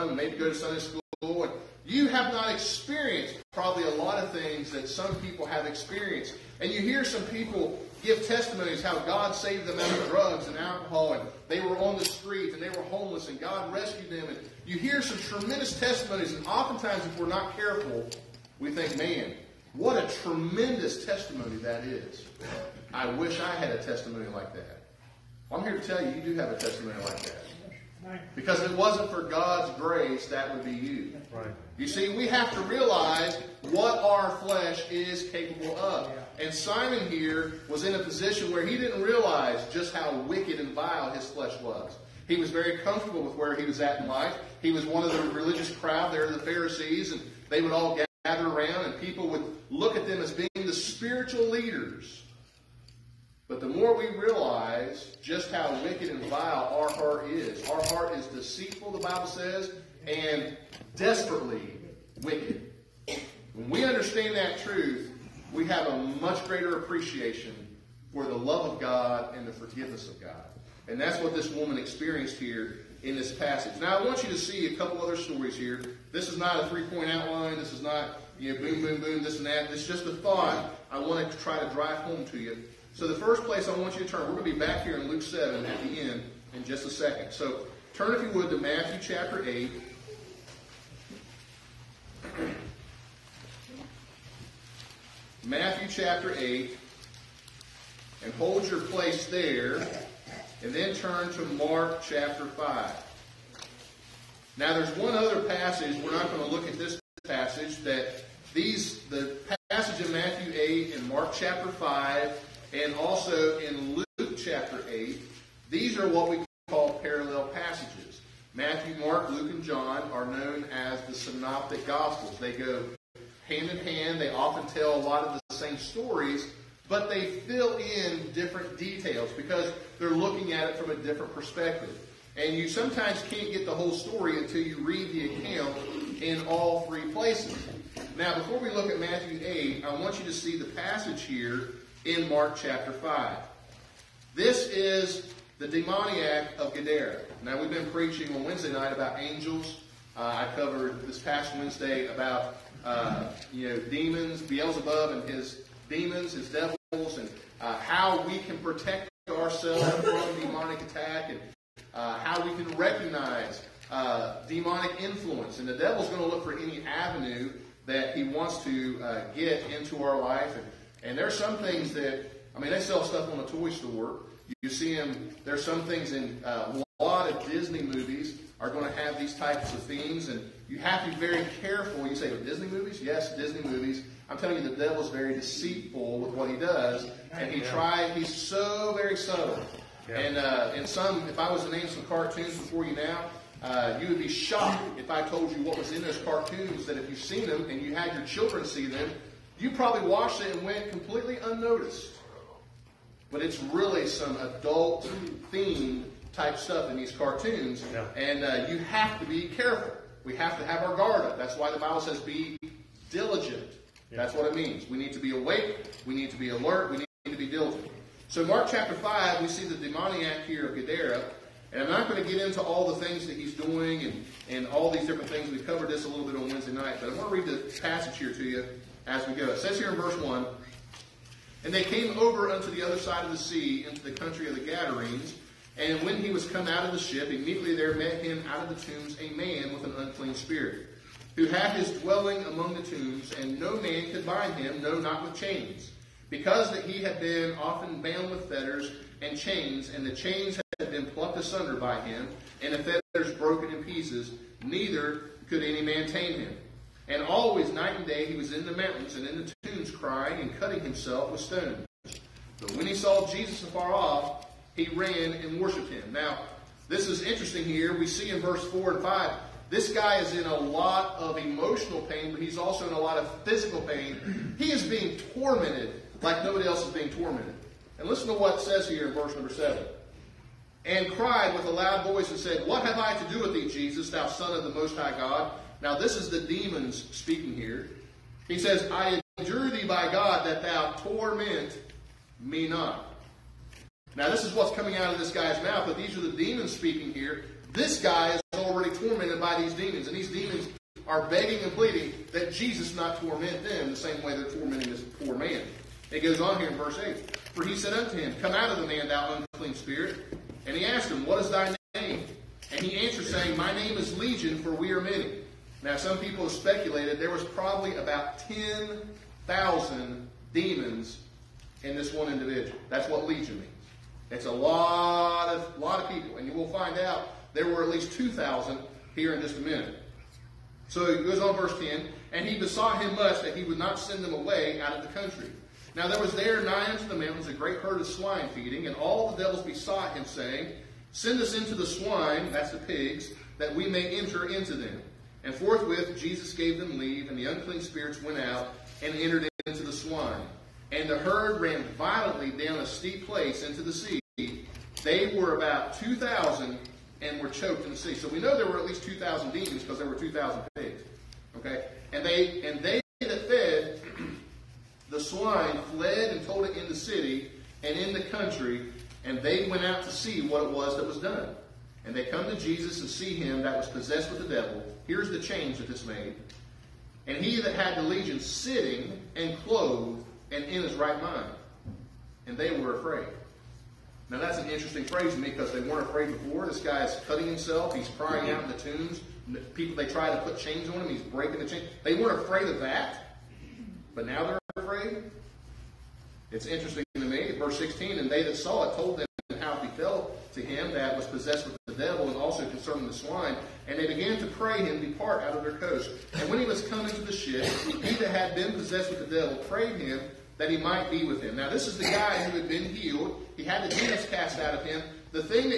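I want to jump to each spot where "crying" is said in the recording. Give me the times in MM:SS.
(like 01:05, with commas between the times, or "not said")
04:19, 06:28.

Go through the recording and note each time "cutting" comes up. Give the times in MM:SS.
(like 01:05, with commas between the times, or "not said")
04:20, 06:27.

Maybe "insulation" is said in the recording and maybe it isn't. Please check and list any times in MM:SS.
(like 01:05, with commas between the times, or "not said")
not said.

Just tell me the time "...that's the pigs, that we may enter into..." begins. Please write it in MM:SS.
05:42.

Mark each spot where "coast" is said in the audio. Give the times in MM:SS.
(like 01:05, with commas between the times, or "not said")
06:45.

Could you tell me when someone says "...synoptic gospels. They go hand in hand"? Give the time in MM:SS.
02:01.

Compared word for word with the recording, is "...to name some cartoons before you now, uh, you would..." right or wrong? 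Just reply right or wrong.
right.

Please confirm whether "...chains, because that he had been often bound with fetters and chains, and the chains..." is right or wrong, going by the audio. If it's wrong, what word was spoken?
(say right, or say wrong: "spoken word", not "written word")
right.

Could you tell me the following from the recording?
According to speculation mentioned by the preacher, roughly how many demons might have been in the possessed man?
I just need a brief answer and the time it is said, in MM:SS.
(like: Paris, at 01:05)
10,000, at 05:18.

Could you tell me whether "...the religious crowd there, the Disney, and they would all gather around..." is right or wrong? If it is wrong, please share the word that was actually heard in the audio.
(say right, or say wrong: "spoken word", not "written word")
wrong: "Pharisees", not "Disney".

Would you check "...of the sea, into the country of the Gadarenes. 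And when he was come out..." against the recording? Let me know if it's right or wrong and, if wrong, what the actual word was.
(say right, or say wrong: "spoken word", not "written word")
right.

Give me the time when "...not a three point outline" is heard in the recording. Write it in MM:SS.
01:16.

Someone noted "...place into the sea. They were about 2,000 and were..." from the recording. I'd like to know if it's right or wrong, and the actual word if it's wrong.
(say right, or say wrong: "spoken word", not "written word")
right.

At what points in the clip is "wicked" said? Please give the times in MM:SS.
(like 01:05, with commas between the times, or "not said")
00:40, 00:55, 01:02.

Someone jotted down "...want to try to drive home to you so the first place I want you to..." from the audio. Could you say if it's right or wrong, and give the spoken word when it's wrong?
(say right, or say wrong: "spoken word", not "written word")
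right.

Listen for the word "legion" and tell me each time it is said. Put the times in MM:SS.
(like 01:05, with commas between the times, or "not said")
05:14, 05:23, 06:18.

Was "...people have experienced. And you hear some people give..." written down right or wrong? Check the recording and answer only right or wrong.
right.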